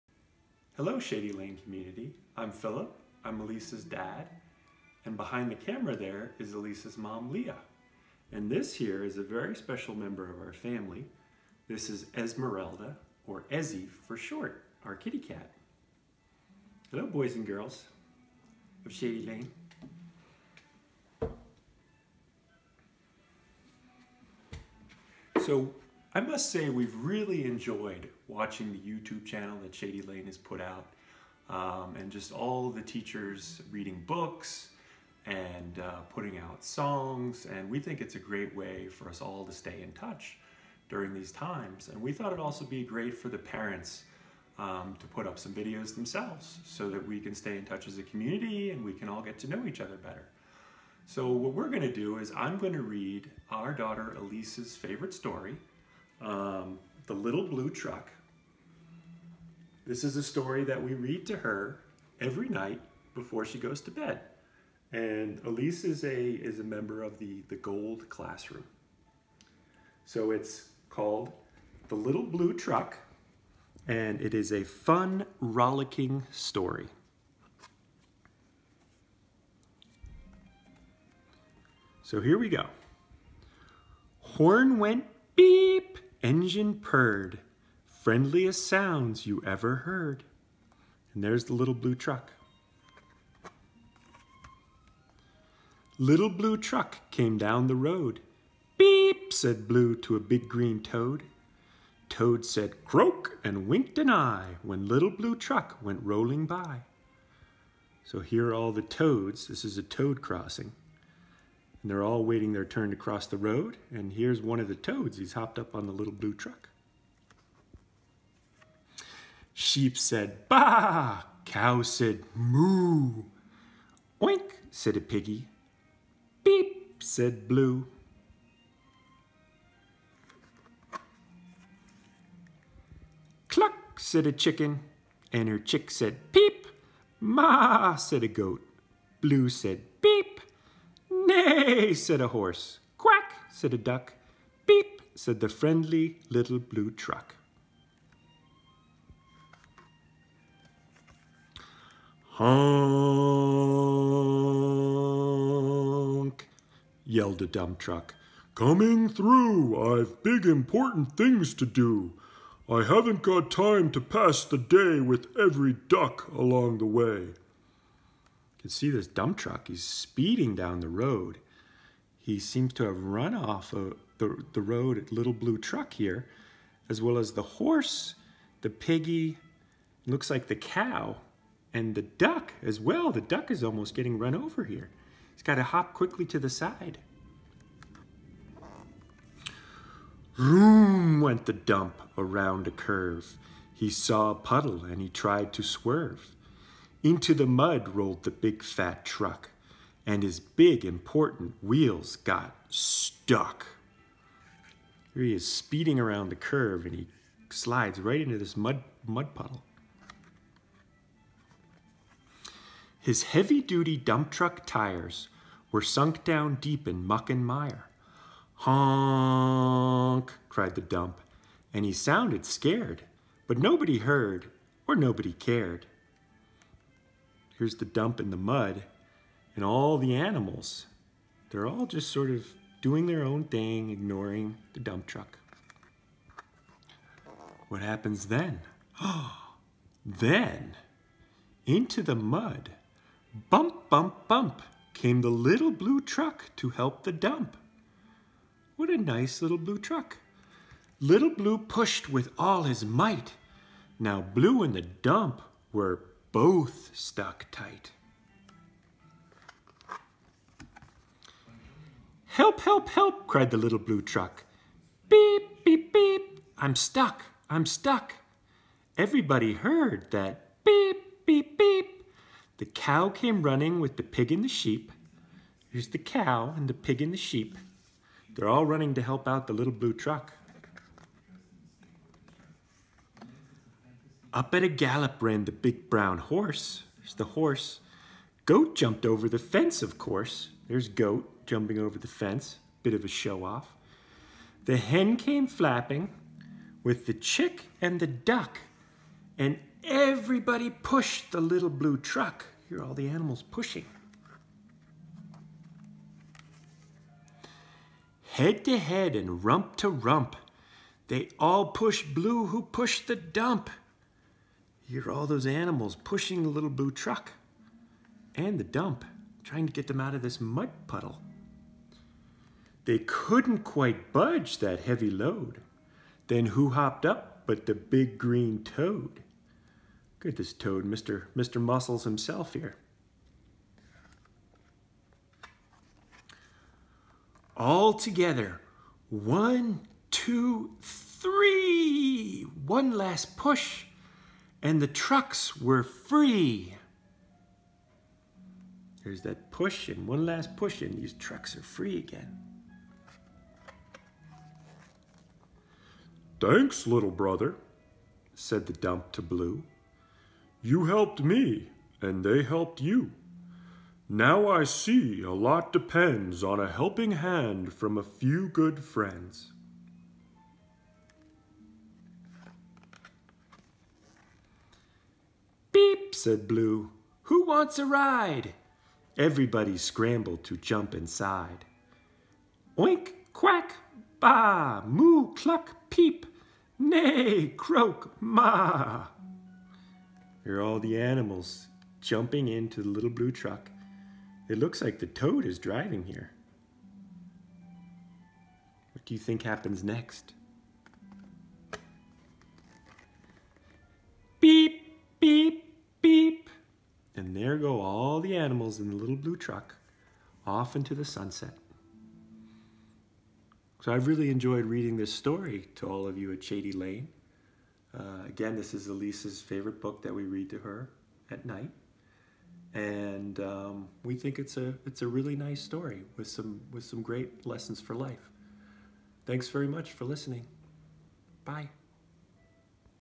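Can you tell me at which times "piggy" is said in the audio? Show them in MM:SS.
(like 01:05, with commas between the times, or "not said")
02:05, 02:58.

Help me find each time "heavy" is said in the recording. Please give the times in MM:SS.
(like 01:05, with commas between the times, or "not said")
03:33, 05:24.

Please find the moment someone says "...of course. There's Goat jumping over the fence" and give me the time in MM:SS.
04:49.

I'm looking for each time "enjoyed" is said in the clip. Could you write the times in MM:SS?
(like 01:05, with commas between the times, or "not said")
00:27, 06:54.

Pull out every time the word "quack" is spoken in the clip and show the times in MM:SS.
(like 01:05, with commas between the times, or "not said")
02:22, 06:23.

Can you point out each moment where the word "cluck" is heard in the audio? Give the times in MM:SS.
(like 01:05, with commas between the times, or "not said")
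02:13, 06:25.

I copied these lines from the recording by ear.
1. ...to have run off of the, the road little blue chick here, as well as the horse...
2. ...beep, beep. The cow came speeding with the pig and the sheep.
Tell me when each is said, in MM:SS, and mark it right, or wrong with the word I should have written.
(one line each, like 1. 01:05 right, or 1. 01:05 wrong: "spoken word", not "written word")
1. 02:52 wrong: "truck", not "chick"
2. 04:31 wrong: "running", not "speeding".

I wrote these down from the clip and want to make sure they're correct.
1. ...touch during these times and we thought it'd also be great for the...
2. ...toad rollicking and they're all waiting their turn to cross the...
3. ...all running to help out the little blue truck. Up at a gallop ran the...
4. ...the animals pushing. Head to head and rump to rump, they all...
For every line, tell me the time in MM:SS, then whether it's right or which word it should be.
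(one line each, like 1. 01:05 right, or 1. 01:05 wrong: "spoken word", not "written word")
1. 00:39 right
2. 01:49 wrong: "crossing", not "rollicking"
3. 04:38 right
4. 05:02 right.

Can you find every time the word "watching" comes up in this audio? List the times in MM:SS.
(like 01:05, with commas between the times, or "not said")
00:28.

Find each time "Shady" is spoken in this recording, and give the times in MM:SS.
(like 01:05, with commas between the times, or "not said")
00:00, 00:18, 00:29, 06:56.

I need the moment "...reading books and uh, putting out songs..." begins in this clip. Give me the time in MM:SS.
00:33.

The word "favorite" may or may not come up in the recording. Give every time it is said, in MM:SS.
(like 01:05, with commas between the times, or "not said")
00:54, 06:59.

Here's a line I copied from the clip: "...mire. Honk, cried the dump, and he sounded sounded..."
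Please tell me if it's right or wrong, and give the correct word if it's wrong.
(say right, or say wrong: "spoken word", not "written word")
wrong: "scared", not "sounded".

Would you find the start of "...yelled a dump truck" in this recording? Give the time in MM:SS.
02:37.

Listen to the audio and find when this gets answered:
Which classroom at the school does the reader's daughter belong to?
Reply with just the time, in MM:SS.
01:07.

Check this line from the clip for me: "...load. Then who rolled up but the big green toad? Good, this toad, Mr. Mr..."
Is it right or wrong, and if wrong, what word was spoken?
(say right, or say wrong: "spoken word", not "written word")
wrong: "hopped", not "rolled".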